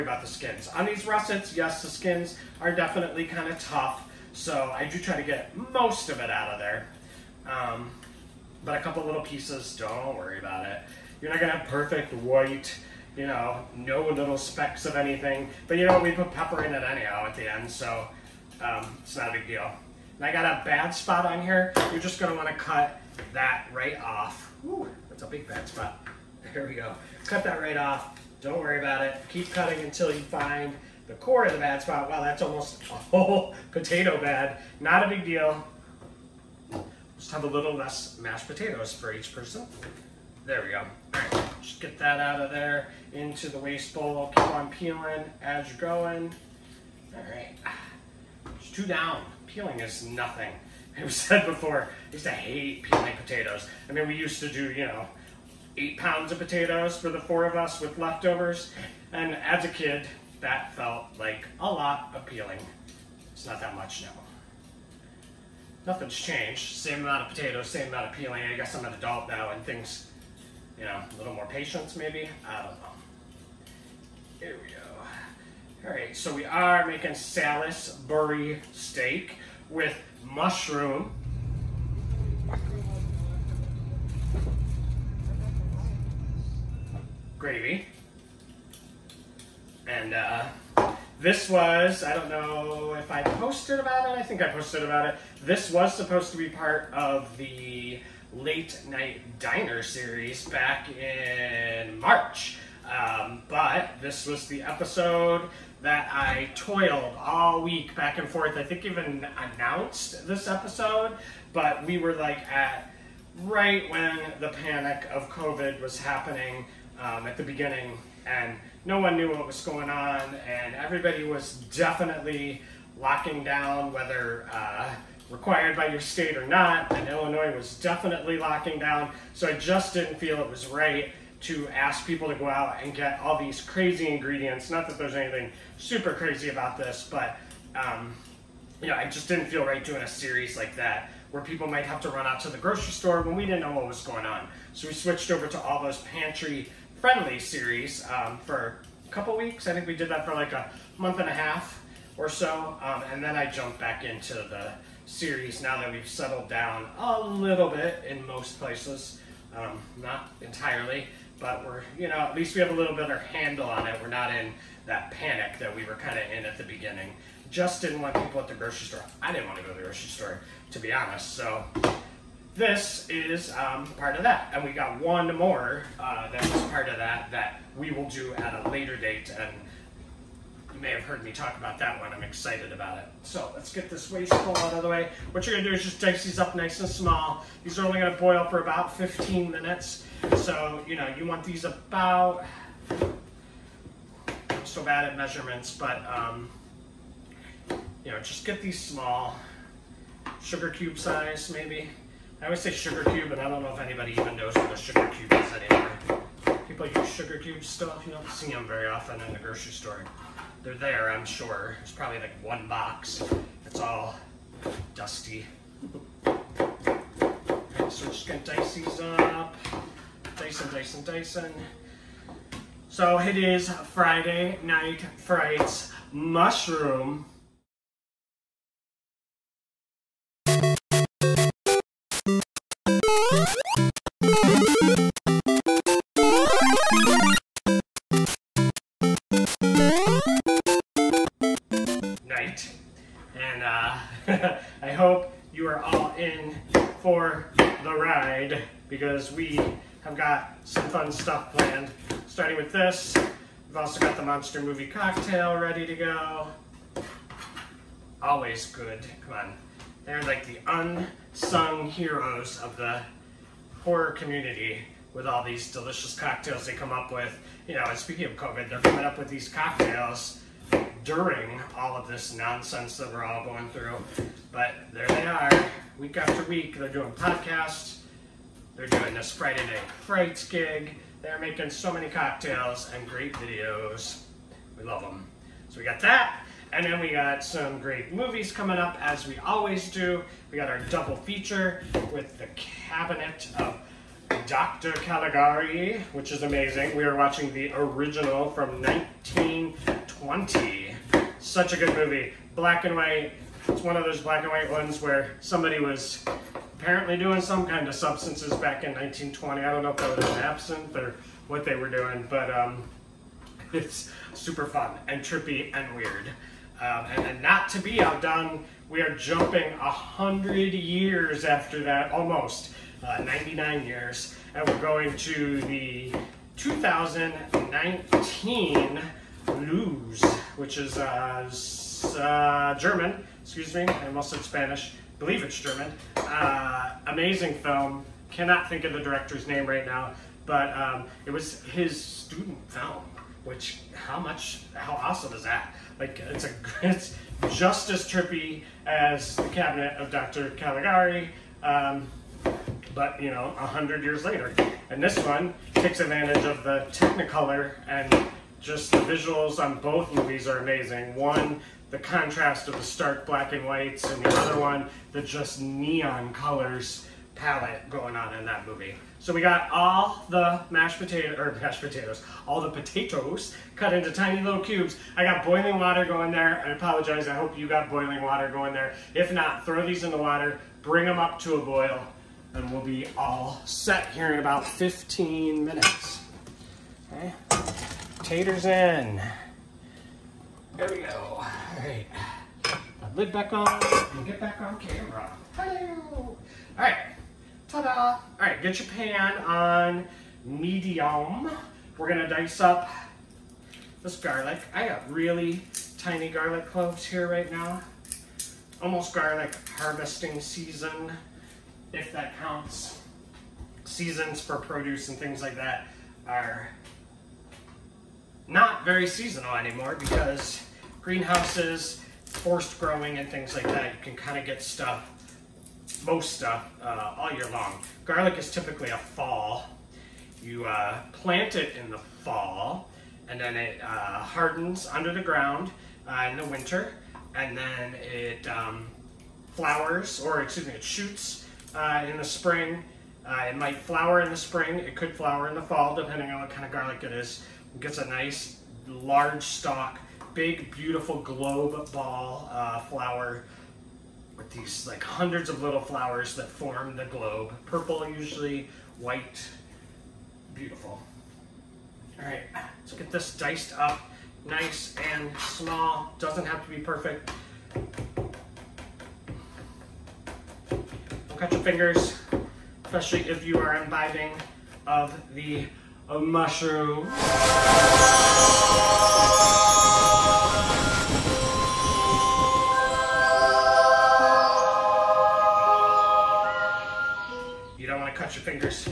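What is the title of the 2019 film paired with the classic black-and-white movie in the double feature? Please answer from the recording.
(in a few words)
Luz.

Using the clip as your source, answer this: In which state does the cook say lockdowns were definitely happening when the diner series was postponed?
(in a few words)
Illinois.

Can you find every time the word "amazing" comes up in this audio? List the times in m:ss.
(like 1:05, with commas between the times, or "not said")
4:56, 5:37, 6:00.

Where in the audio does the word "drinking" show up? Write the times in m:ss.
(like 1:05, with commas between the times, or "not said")
not said.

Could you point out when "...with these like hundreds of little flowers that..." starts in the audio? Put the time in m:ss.
7:34.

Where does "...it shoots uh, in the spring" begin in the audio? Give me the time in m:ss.
7:20.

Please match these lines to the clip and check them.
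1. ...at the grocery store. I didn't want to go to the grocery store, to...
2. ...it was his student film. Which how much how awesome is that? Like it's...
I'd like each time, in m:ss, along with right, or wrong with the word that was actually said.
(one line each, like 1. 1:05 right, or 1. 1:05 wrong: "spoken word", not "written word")
1. 2:48 right
2. 5:41 right.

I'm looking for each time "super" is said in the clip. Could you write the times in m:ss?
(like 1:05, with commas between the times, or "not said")
2:15, 5:14.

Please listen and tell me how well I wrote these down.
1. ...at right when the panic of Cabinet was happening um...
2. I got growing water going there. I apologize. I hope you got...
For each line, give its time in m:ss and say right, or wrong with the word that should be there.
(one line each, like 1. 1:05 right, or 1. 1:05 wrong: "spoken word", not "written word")
1. 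1:52 wrong: "COVID", not "Cabinet"
2. 6:15 wrong: "boiling", not "growing".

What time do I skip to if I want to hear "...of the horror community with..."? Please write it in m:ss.
4:22.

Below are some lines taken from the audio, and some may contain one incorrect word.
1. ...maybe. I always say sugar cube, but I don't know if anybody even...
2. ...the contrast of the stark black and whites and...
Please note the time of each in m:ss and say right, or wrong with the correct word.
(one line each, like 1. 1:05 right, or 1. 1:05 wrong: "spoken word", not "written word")
1. 3:21 right
2. 6:01 right.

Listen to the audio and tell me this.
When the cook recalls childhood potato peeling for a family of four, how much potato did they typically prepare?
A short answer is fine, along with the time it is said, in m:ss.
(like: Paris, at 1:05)
8 pounds, at 0:55.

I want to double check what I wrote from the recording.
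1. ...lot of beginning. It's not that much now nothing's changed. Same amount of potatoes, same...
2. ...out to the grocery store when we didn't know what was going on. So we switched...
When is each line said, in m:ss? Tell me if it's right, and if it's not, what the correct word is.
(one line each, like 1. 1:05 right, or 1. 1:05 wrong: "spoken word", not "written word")
1. 1:01 wrong: "peeling", not "beginning"
2. 2:22 right.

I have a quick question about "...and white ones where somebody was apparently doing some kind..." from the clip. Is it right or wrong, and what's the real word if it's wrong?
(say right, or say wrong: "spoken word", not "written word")
right.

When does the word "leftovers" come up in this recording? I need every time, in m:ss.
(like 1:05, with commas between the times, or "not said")
0:57.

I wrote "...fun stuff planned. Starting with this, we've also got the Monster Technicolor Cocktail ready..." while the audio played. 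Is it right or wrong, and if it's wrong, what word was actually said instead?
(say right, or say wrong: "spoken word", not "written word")
wrong: "Movie", not "Technicolor".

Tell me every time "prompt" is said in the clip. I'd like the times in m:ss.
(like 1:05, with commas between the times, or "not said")
not said.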